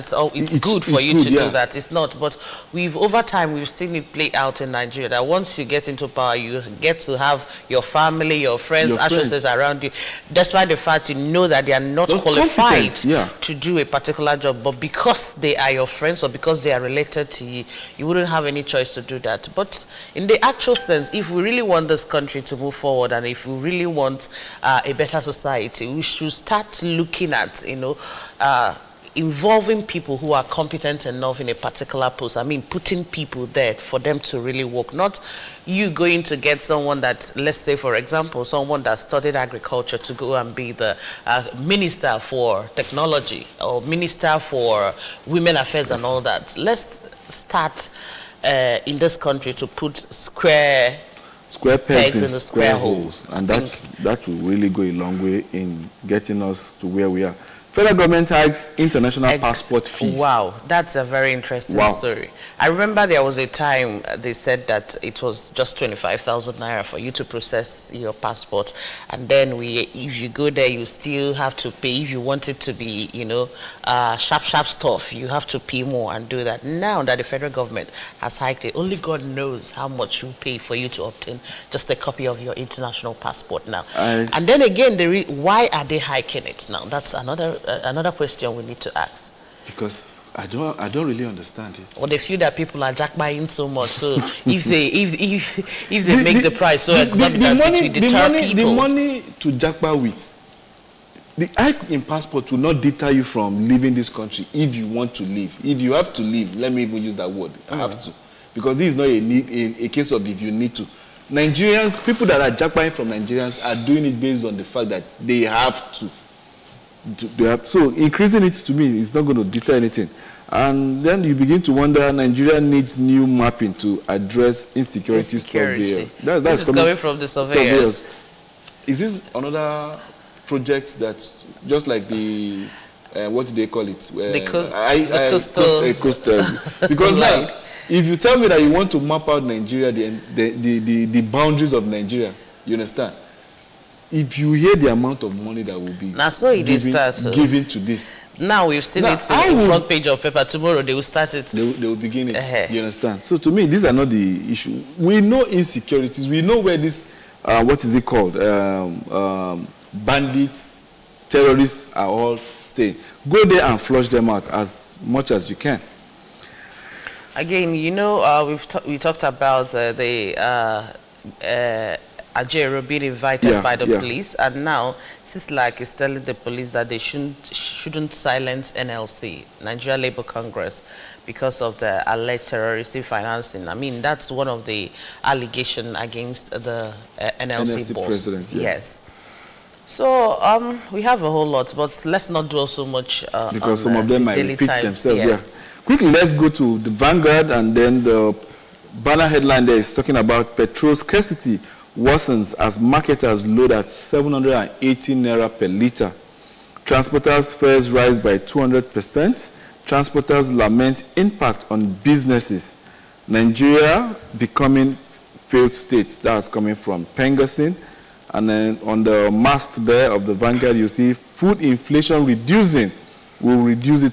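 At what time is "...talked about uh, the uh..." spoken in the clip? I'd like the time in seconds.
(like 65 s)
168 s.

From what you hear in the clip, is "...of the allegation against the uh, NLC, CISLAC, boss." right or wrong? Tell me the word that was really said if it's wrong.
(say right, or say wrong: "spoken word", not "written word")
wrong: "NLC", not "CISLAC".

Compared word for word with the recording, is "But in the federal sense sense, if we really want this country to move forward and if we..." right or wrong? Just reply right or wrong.
wrong.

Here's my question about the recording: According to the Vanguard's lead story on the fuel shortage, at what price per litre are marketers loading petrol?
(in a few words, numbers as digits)
780 naira.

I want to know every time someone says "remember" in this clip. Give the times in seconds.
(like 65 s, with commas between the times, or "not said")
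62 s.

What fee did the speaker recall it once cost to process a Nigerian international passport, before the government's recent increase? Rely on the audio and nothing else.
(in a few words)
25,000 naira.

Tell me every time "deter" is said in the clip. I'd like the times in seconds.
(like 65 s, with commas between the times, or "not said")
98 s, 102 s, 119 s.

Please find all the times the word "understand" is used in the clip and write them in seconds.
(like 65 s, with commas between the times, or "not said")
91 s, 142 s, 152 s.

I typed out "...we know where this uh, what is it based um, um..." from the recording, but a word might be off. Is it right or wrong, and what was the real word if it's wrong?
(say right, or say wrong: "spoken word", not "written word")
wrong: "called", not "based".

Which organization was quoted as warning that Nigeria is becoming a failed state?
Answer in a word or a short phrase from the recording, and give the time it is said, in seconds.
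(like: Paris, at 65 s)
PENGASSAN, at 217 s.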